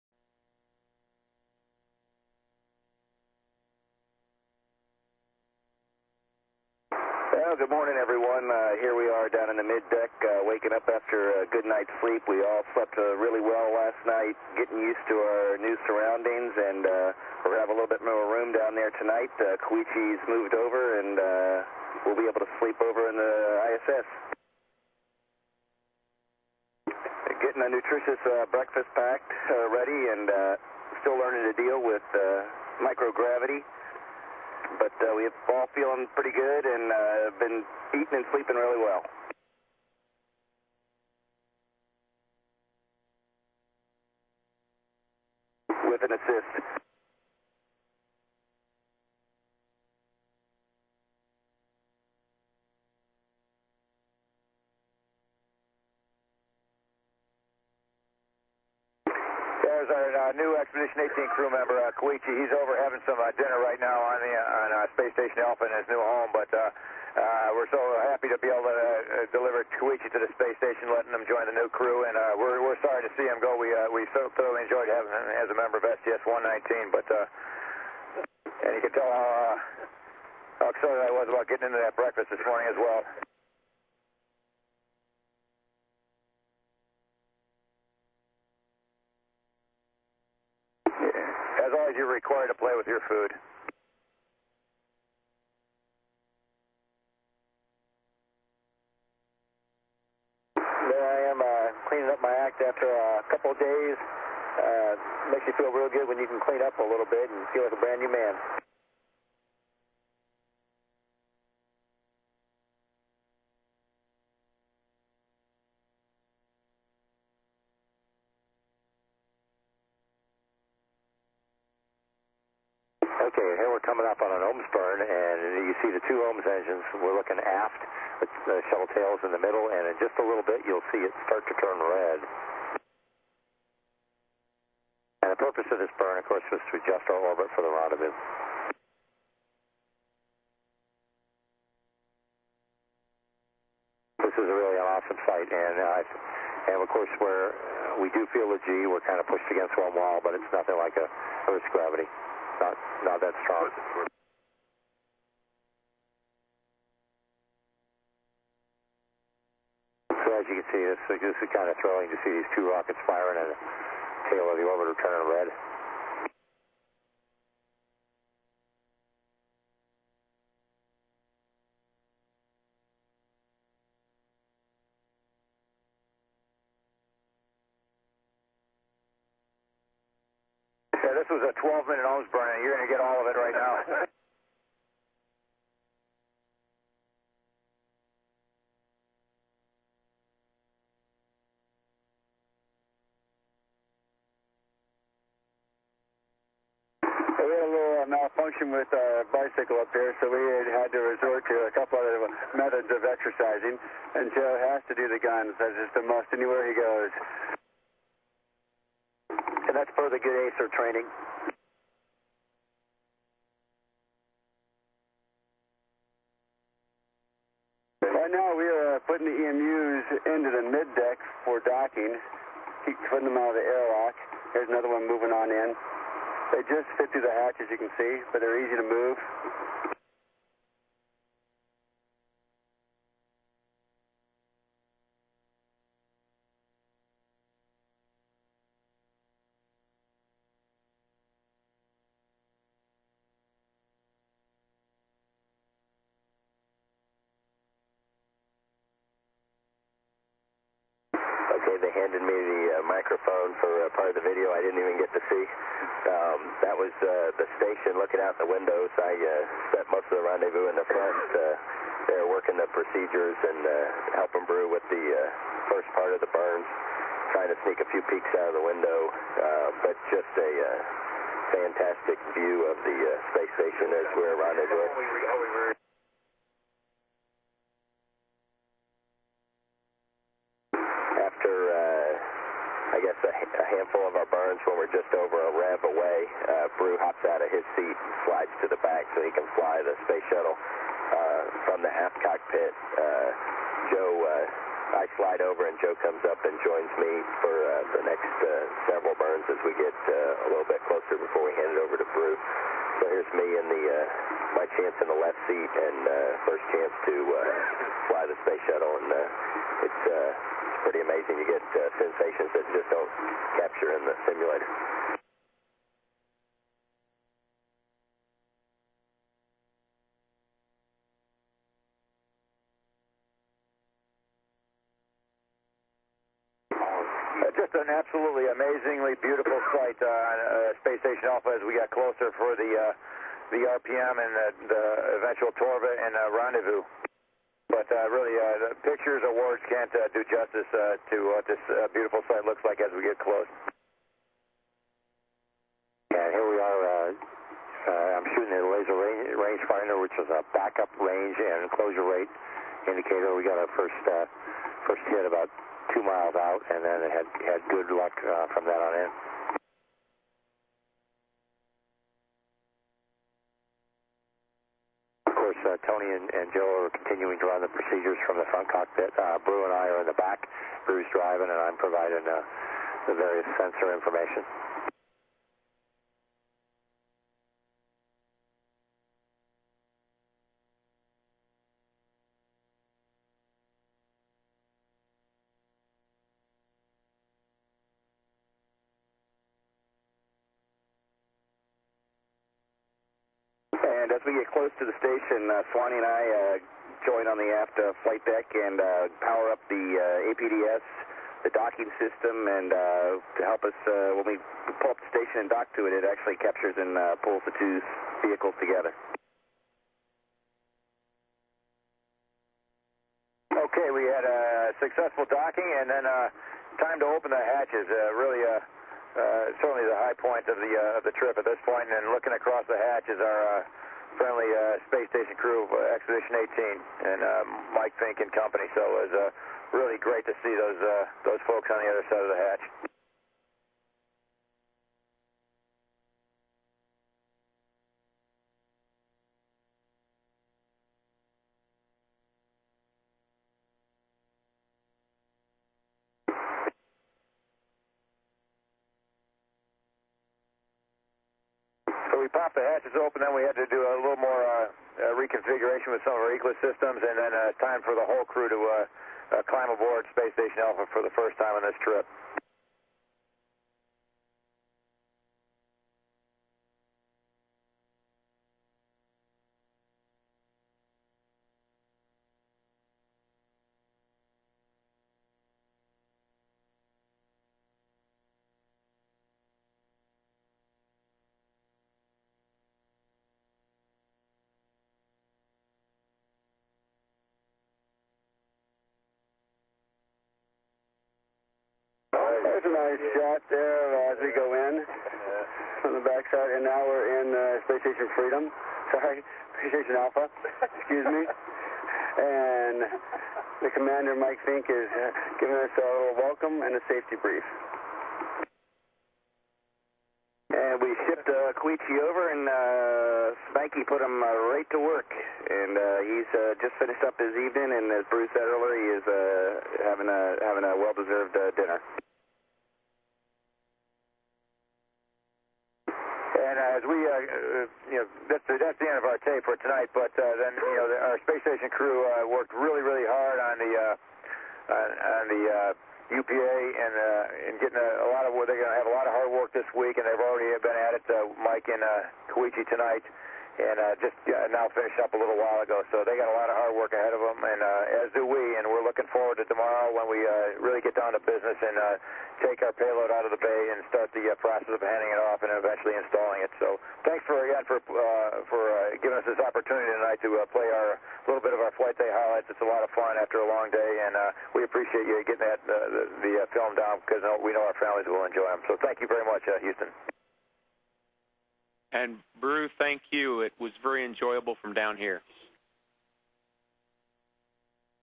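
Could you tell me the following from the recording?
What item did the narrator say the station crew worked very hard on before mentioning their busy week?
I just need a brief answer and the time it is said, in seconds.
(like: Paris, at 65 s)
UPA, at 536 s.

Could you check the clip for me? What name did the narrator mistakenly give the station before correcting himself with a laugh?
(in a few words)
Space Station Freedom.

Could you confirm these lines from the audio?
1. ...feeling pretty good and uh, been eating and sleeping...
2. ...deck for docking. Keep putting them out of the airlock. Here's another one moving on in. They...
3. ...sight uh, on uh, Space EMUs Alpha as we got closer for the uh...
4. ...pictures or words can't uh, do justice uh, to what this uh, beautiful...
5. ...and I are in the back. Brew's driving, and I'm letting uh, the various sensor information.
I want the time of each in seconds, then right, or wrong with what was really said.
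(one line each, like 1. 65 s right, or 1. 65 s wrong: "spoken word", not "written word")
1. 35 s right
2. 220 s right
3. 329 s wrong: "Station", not "EMUs"
4. 338 s right
5. 369 s wrong: "providing", not "letting".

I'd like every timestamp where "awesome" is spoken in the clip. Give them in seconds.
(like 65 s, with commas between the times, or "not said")
144 s.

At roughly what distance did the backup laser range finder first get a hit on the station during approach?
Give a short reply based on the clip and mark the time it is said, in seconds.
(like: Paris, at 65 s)
2 miles, at 355 s.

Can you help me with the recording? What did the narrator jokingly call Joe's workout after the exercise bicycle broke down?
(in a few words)
ACER training.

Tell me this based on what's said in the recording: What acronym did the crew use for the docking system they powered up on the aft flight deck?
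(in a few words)
APDS.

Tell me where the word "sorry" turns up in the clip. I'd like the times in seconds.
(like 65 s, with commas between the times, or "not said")
72 s, 498 s.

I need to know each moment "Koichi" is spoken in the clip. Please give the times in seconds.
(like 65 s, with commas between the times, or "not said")
19 s, 61 s, 69 s, 511 s, 542 s.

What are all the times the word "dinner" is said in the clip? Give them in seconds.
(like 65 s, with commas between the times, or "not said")
63 s, 521 s.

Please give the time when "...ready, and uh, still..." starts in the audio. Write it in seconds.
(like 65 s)
29 s.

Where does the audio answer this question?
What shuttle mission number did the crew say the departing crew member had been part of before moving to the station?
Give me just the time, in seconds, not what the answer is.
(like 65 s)
76 s.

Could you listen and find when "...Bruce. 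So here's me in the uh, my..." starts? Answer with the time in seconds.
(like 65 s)
302 s.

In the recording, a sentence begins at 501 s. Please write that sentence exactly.
and the commander, Mike Fincke, is uh, giving us a little welcome and a safety brief.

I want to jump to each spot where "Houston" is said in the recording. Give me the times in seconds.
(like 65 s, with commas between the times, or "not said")
569 s.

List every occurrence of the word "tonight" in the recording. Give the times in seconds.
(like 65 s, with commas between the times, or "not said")
18 s, 529 s, 542 s, 559 s.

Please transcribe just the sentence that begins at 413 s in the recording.
Okay, we had a successful docking and then uh, time to open the hatches.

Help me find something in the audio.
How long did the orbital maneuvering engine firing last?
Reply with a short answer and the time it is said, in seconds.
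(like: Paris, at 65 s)
12 minutes, at 181 s.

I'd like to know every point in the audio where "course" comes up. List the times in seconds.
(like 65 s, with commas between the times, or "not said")
136 s, 146 s, 365 s.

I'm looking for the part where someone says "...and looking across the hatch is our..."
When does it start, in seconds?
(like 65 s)
421 s.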